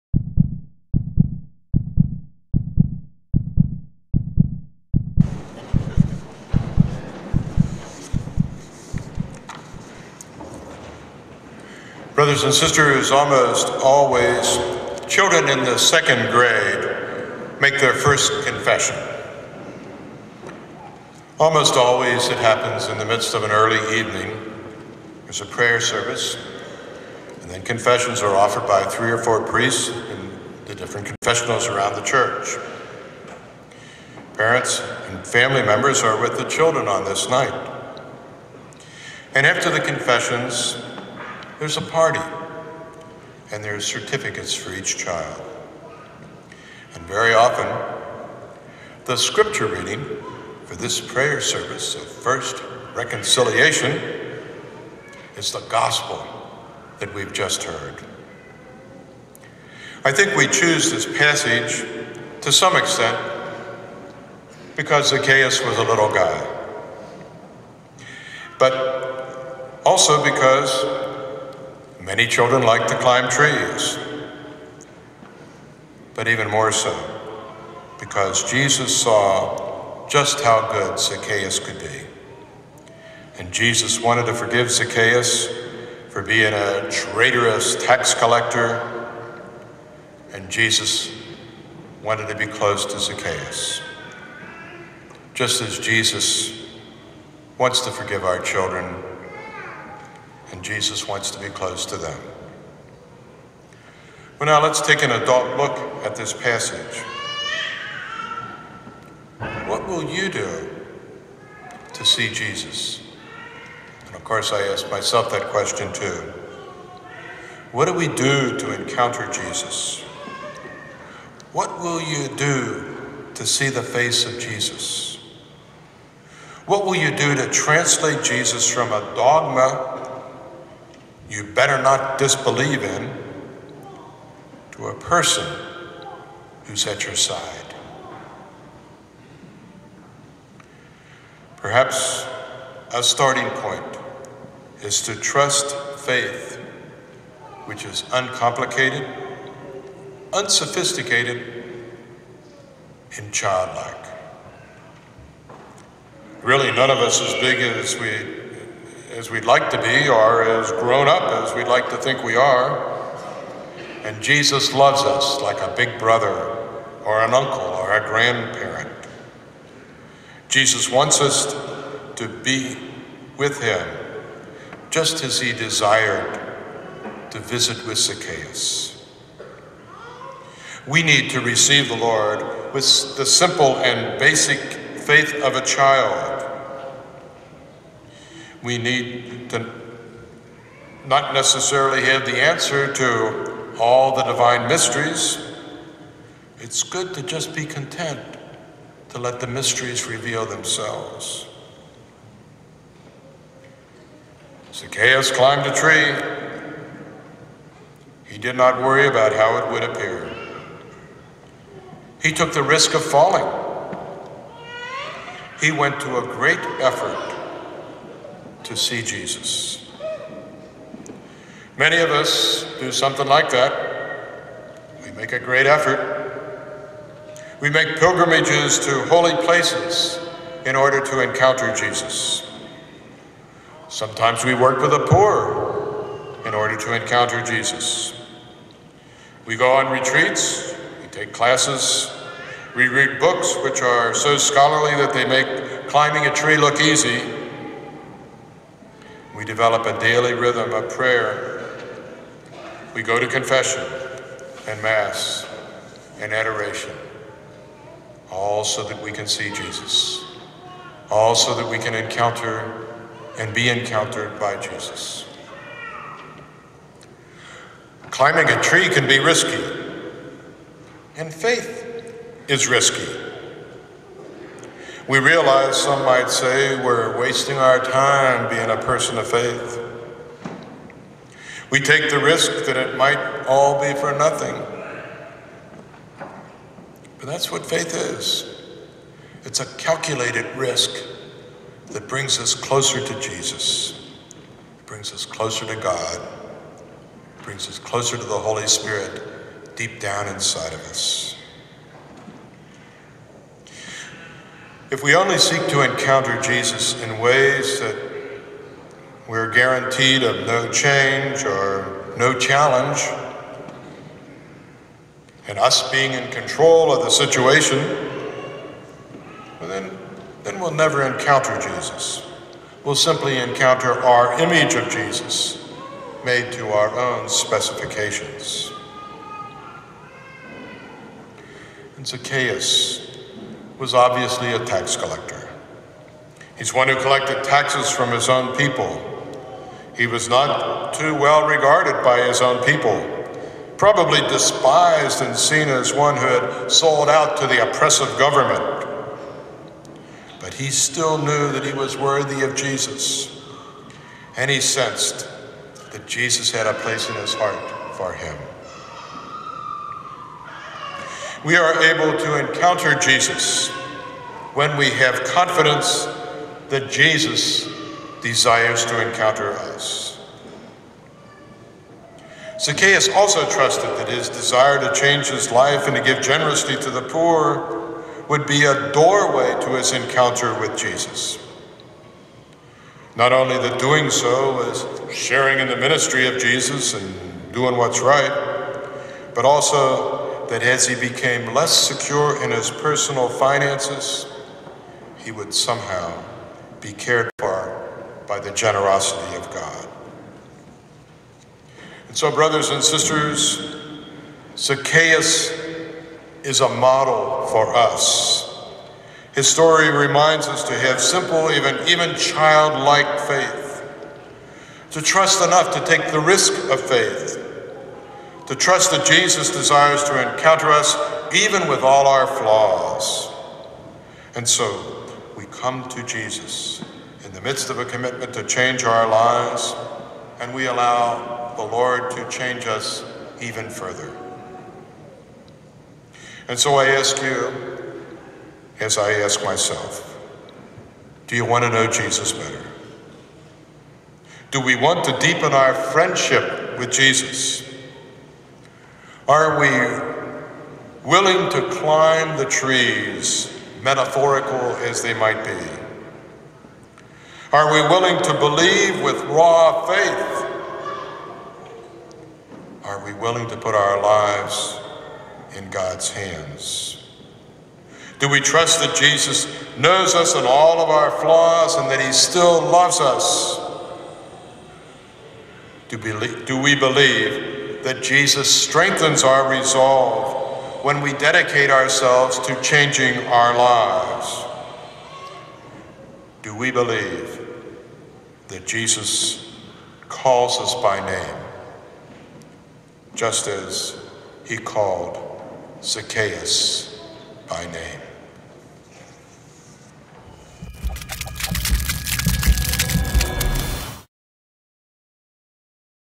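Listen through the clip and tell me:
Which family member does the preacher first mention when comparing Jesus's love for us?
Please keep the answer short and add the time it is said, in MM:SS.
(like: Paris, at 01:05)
big brother, at 02:45.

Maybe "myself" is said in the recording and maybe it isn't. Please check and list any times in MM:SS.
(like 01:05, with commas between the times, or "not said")
01:54, 07:19.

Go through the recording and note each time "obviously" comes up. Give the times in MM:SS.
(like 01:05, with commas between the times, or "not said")
05:33.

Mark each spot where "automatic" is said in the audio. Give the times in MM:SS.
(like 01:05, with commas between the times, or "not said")
not said.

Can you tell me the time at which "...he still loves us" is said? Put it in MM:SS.
07:52.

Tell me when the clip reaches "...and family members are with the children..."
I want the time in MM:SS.
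00:35.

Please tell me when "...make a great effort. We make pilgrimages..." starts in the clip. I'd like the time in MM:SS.
03:45.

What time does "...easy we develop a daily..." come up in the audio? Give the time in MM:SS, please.
04:06.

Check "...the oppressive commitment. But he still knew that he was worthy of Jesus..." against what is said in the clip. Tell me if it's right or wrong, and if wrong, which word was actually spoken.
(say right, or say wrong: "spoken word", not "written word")
wrong: "government", not "commitment".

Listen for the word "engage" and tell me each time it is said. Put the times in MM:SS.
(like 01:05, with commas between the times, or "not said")
not said.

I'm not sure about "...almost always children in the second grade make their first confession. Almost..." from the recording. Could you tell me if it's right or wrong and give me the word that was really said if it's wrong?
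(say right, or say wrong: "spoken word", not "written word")
right.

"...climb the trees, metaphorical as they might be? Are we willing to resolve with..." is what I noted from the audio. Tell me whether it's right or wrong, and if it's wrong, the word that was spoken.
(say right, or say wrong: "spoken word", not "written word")
wrong: "believe", not "resolve".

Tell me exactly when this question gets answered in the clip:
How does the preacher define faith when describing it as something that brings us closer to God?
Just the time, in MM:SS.
04:49.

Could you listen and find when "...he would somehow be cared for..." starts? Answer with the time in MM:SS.
06:35.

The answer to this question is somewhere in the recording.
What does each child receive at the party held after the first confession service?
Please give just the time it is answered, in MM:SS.
00:43.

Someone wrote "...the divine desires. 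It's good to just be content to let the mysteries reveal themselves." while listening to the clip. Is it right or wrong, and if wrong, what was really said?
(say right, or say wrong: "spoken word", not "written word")
wrong: "mysteries", not "desires".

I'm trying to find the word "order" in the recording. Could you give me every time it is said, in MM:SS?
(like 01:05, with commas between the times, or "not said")
03:50, 03:56.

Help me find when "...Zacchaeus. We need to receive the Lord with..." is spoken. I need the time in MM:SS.
02:57.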